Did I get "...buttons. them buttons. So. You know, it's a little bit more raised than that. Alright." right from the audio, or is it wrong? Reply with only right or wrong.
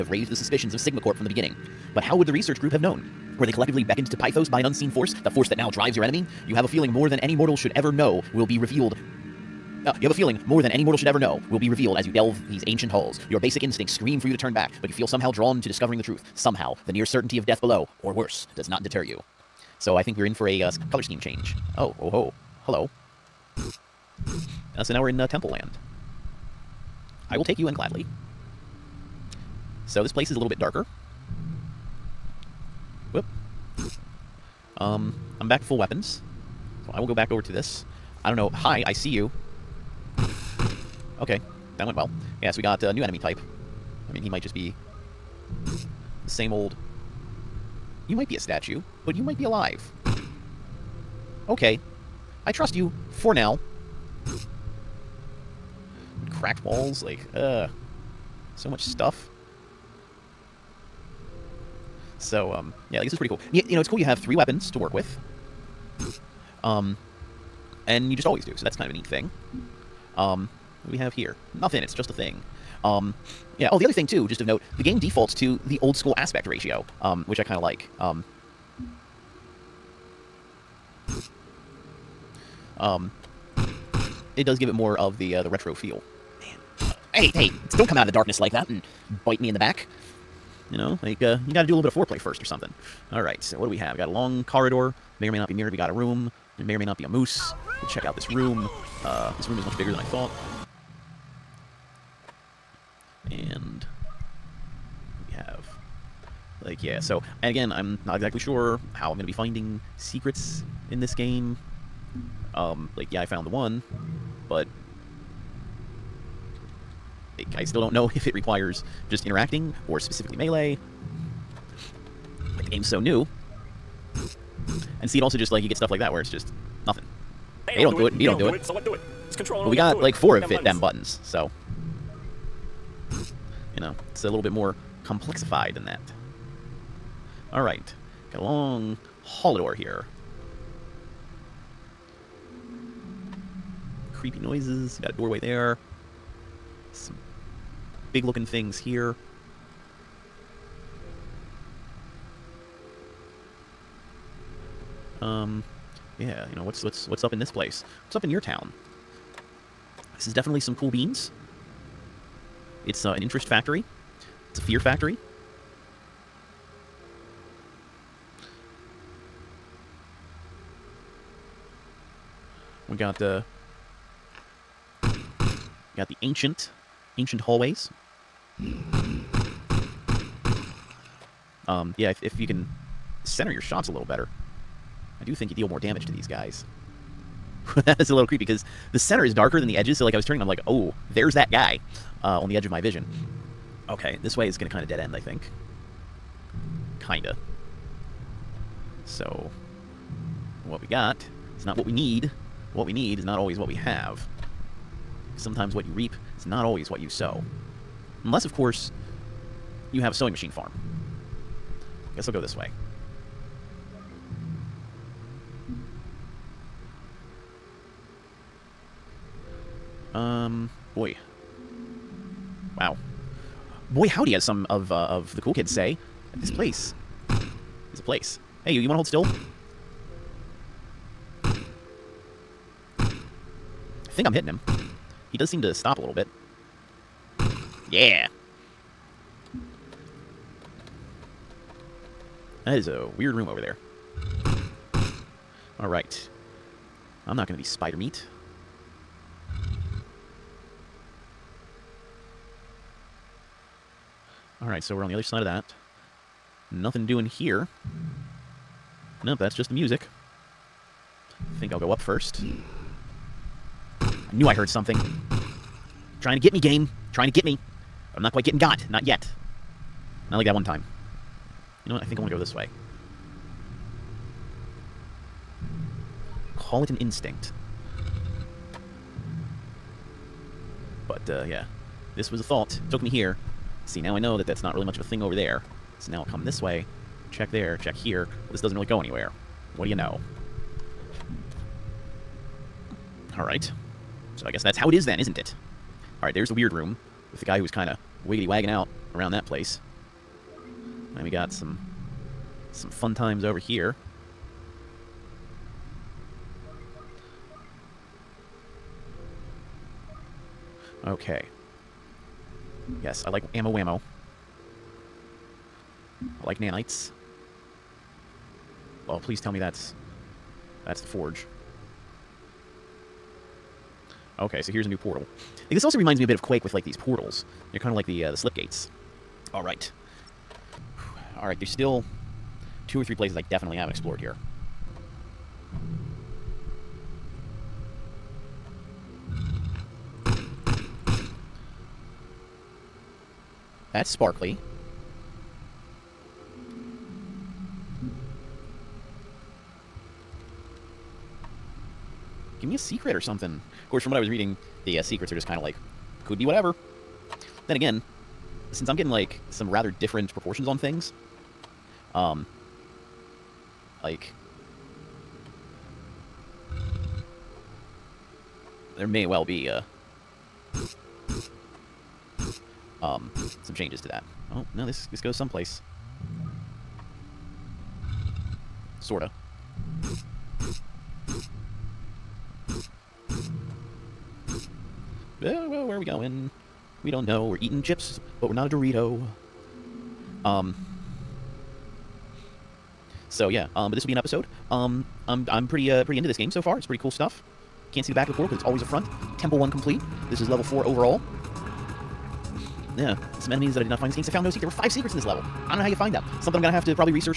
wrong.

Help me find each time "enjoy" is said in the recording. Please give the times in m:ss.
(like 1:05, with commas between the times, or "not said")
not said.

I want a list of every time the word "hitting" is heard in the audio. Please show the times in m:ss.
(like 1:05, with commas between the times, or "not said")
3:54.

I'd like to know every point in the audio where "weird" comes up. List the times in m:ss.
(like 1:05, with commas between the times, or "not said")
4:03, 4:56.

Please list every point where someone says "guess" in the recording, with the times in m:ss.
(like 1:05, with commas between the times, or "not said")
3:32, 4:54.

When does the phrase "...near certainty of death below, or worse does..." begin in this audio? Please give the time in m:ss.
0:16.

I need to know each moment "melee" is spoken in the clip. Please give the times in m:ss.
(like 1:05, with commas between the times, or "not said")
2:00.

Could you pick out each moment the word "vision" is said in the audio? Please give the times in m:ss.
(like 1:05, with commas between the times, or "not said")
3:12.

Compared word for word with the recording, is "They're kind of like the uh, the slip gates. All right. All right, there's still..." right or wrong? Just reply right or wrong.
right.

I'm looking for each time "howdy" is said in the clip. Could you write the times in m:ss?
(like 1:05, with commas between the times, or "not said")
3:44.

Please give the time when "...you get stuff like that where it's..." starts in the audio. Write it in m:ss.
2:05.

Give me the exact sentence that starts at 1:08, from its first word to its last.
So that's kind of a neat thing.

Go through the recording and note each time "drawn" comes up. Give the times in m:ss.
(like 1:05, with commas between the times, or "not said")
0:15.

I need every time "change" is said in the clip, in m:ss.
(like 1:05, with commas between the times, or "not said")
0:21, 6:13.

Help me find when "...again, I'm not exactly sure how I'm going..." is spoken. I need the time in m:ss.
1:47.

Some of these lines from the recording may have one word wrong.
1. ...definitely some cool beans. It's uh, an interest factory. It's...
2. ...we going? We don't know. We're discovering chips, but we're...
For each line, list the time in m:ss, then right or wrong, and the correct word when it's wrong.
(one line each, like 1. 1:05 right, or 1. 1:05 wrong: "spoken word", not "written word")
1. 2:40 right
2. 6:25 wrong: "eating", not "discovering".